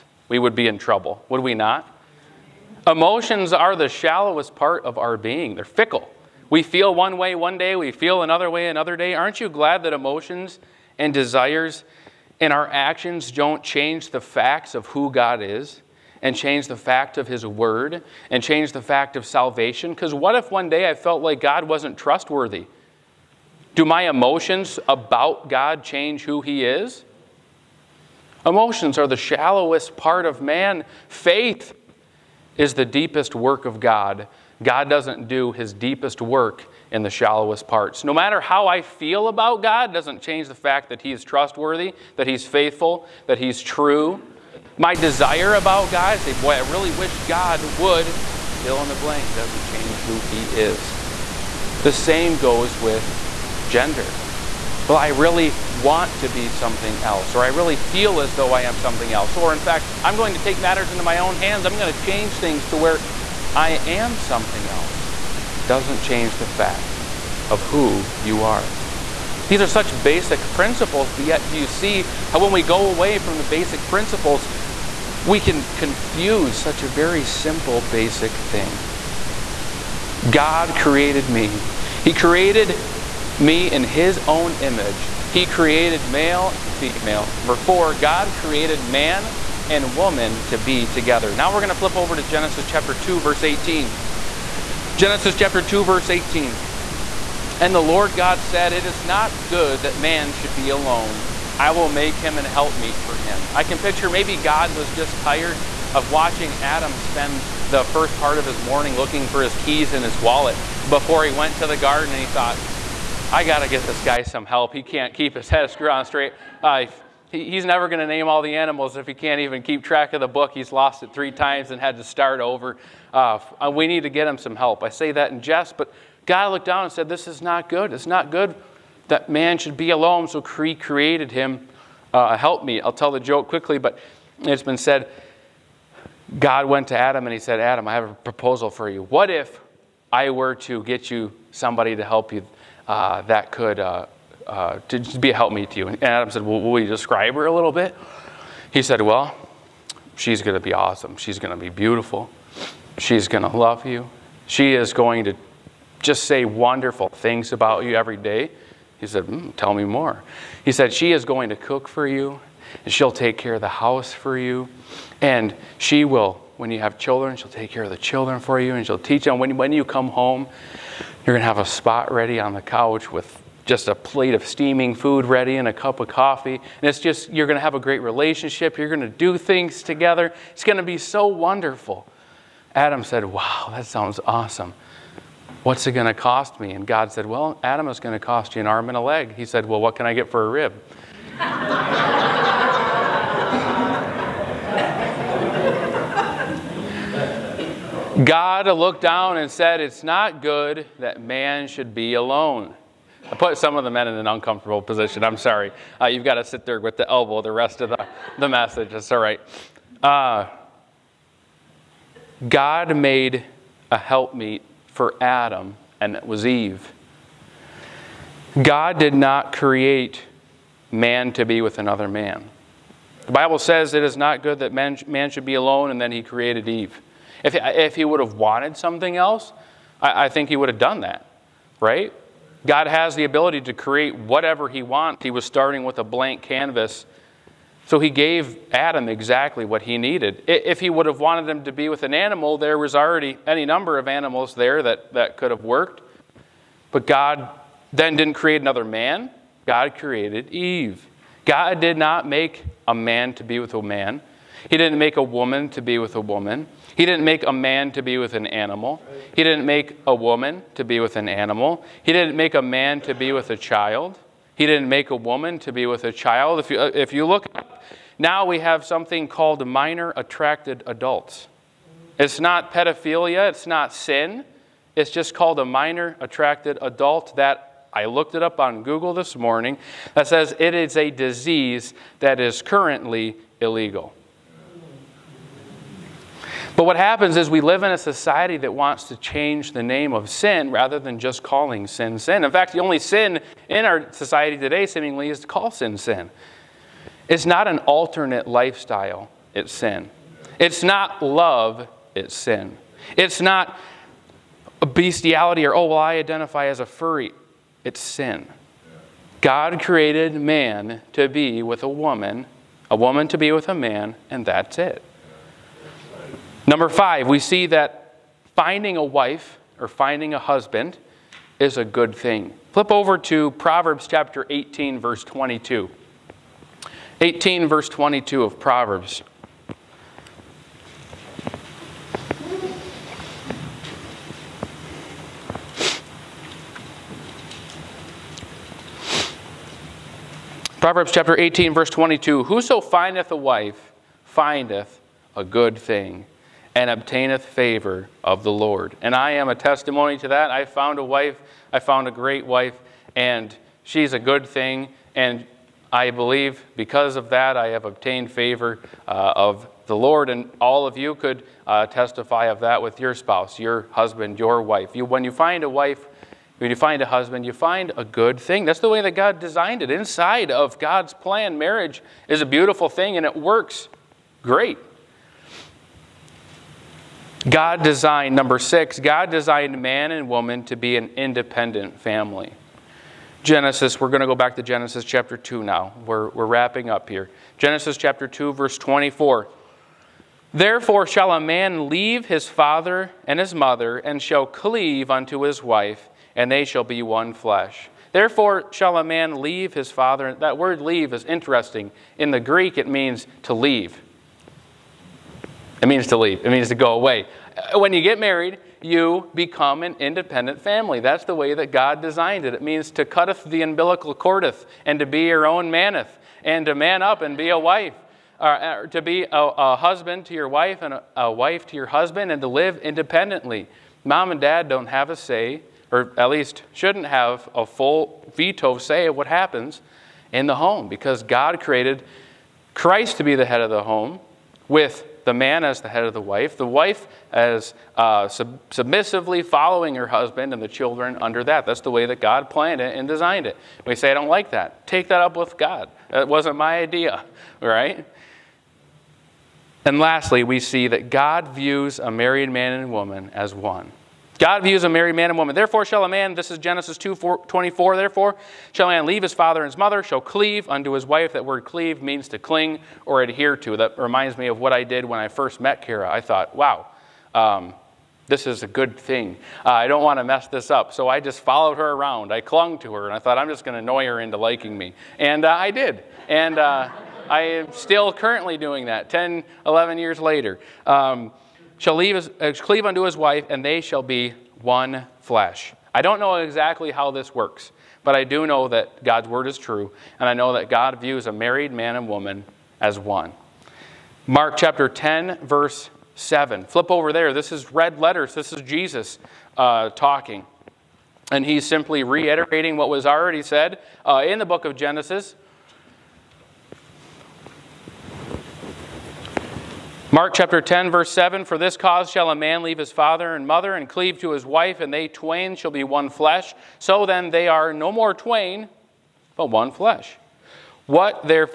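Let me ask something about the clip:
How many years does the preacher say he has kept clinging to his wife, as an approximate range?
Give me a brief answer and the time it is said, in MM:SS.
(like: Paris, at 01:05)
10 to 11 years, at 07:59.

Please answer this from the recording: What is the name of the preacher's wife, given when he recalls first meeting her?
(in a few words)
Kara.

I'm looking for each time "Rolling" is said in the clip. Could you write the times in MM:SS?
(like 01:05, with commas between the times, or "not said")
not said.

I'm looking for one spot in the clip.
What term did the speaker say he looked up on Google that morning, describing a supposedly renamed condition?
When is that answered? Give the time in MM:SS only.
04:35.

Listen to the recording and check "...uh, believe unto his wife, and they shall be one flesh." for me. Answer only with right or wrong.
wrong.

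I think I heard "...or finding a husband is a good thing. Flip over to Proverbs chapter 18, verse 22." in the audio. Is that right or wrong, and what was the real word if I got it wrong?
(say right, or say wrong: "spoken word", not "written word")
right.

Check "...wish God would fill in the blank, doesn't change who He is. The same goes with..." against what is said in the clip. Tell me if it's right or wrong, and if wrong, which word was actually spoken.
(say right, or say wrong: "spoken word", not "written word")
right.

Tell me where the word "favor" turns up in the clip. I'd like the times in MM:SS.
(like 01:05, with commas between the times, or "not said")
05:47, 05:58.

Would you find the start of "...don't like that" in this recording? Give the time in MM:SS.
07:24.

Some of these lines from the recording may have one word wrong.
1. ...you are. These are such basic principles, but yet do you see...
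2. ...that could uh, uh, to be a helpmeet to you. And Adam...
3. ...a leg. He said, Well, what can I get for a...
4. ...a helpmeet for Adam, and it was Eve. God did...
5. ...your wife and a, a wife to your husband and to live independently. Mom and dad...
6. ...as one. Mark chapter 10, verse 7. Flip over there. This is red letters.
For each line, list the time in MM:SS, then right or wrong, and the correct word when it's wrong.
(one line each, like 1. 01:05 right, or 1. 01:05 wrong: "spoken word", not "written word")
1. 01:08 right
2. 02:23 right
3. 03:08 right
4. 03:33 right
5. 07:00 right
6. 08:12 right.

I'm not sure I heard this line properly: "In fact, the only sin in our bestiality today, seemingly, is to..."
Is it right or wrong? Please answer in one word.
wrong.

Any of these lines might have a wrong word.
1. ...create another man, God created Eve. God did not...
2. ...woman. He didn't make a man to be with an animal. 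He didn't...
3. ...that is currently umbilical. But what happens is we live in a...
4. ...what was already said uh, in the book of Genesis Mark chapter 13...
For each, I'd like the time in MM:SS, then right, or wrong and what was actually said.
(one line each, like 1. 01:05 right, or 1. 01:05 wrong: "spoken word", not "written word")
1. 04:08 right
2. 04:16 right
3. 04:42 wrong: "illegal", not "umbilical"
4. 08:22 wrong: "10", not "13".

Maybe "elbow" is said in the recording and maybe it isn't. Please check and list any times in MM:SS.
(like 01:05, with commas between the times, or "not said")
03:27.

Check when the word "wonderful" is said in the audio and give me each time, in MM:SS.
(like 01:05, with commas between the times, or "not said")
02:36, 03:01.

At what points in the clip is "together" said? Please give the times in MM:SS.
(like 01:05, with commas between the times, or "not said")
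01:30, 02:59.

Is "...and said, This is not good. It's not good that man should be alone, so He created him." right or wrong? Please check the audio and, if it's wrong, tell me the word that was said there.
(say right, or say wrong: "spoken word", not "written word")
right.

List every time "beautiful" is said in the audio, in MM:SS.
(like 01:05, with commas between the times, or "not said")
02:31, 06:12.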